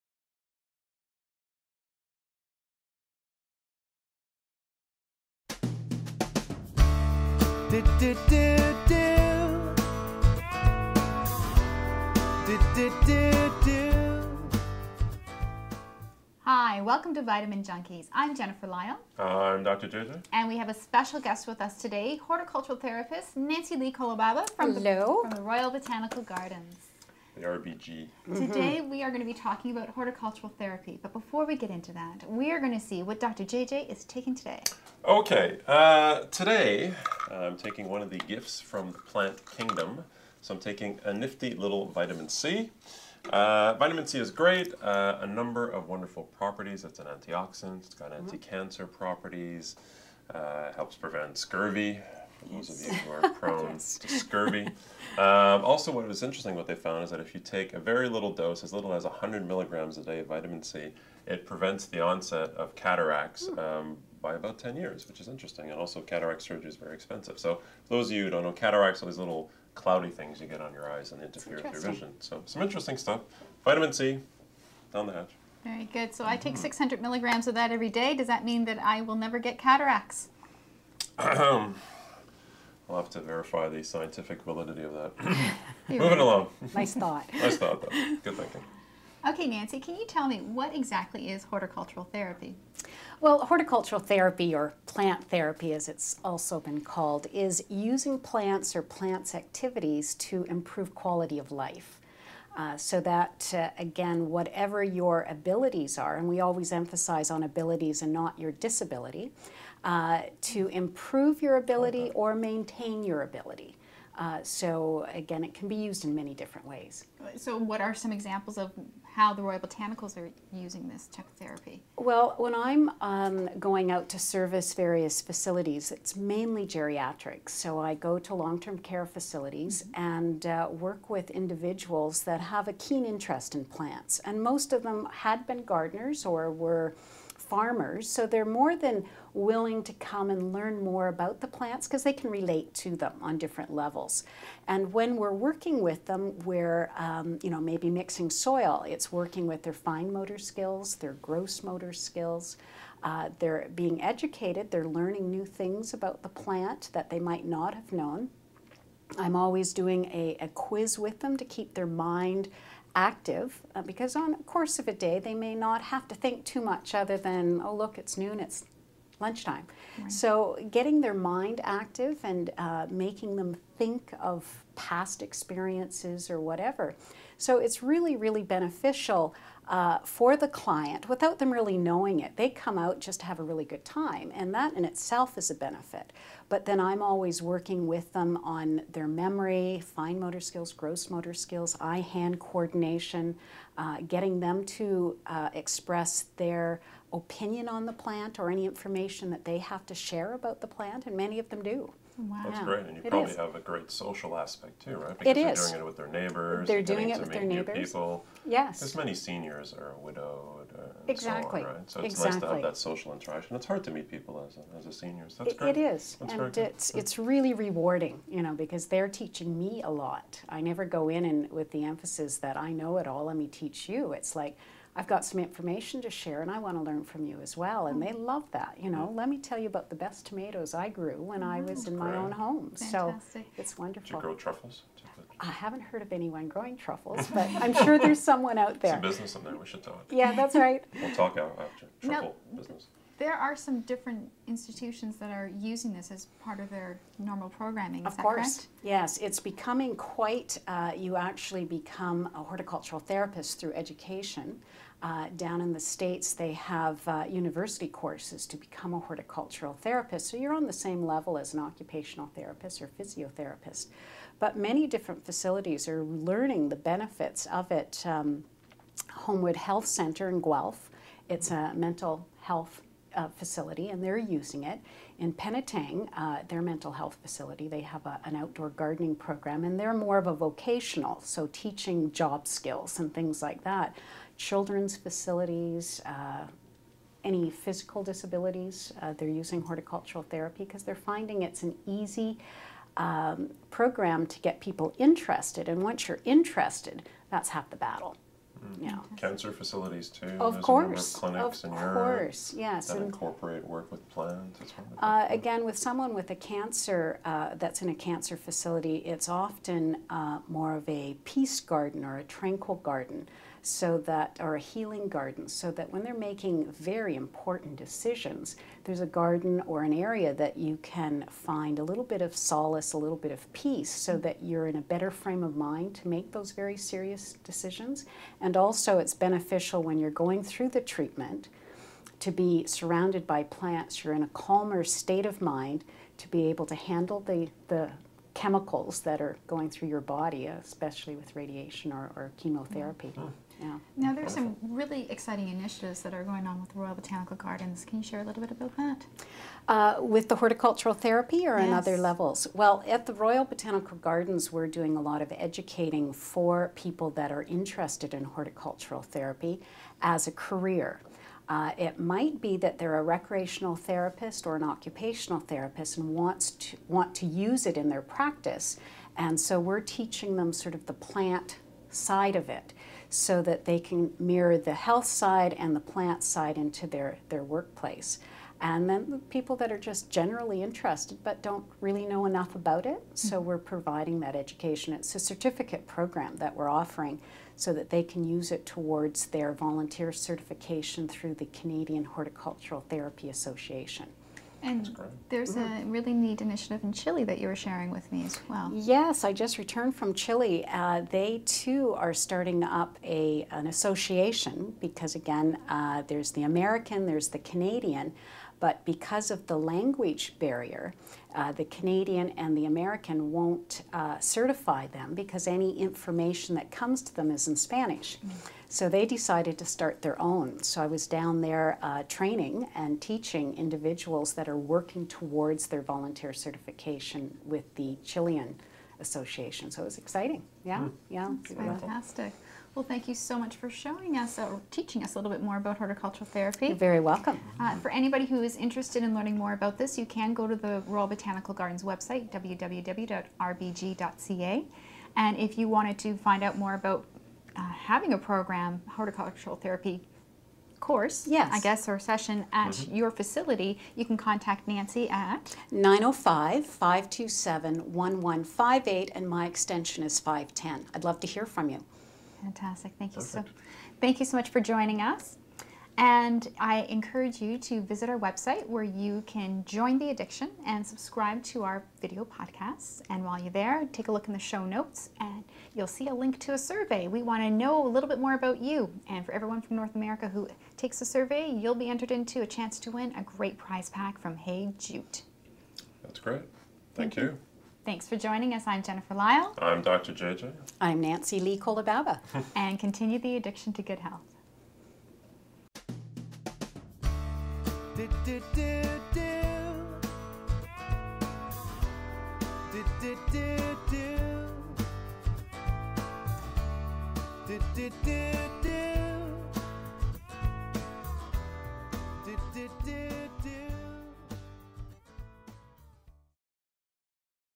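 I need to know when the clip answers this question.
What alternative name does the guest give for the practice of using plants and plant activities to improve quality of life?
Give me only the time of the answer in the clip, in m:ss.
1:34.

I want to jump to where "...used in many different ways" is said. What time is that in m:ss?
1:55.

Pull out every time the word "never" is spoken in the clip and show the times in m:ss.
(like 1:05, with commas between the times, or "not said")
1:19, 3:40.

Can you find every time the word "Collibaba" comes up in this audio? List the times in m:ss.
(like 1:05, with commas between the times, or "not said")
0:23, 8:11.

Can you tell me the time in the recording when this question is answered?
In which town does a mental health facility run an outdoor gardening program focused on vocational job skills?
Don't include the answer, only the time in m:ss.
4:35.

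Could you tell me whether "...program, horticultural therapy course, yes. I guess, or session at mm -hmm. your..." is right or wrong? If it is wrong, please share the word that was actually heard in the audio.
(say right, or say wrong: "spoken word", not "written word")
right.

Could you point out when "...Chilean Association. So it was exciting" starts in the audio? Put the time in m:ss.
7:08.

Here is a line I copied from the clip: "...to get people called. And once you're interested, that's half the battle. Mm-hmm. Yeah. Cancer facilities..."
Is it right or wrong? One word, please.
wrong.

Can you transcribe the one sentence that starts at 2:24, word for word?
And when we're working with them, we're um, you know maybe mixing soil.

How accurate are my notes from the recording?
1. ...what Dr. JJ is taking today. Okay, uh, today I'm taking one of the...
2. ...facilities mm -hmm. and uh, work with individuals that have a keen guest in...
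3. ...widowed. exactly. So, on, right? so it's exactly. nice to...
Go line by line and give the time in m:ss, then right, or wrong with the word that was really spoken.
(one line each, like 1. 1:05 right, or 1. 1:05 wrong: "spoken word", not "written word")
1. 0:33 right
2. 2:09 wrong: "interest", not "guest"
3. 3:29 right.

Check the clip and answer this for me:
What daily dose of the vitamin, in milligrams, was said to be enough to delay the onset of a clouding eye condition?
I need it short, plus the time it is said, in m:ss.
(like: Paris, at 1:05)
100 milligrams, at 0:59.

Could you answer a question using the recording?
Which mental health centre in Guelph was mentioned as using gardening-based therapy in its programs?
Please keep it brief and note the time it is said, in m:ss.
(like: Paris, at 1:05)
Homewood Health Center, at 4:29.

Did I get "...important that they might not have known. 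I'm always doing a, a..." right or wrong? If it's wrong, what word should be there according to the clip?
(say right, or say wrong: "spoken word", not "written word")
wrong: "plant", not "important".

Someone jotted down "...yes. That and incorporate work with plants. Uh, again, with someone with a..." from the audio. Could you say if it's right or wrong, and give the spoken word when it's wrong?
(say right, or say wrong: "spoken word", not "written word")
right.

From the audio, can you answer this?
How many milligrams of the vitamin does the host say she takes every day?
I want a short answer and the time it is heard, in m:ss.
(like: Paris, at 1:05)
600 milligrams, at 1:16.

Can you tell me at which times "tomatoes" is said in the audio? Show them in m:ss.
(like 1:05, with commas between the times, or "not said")
3:50.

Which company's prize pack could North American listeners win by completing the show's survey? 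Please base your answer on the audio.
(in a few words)
Hey Jute.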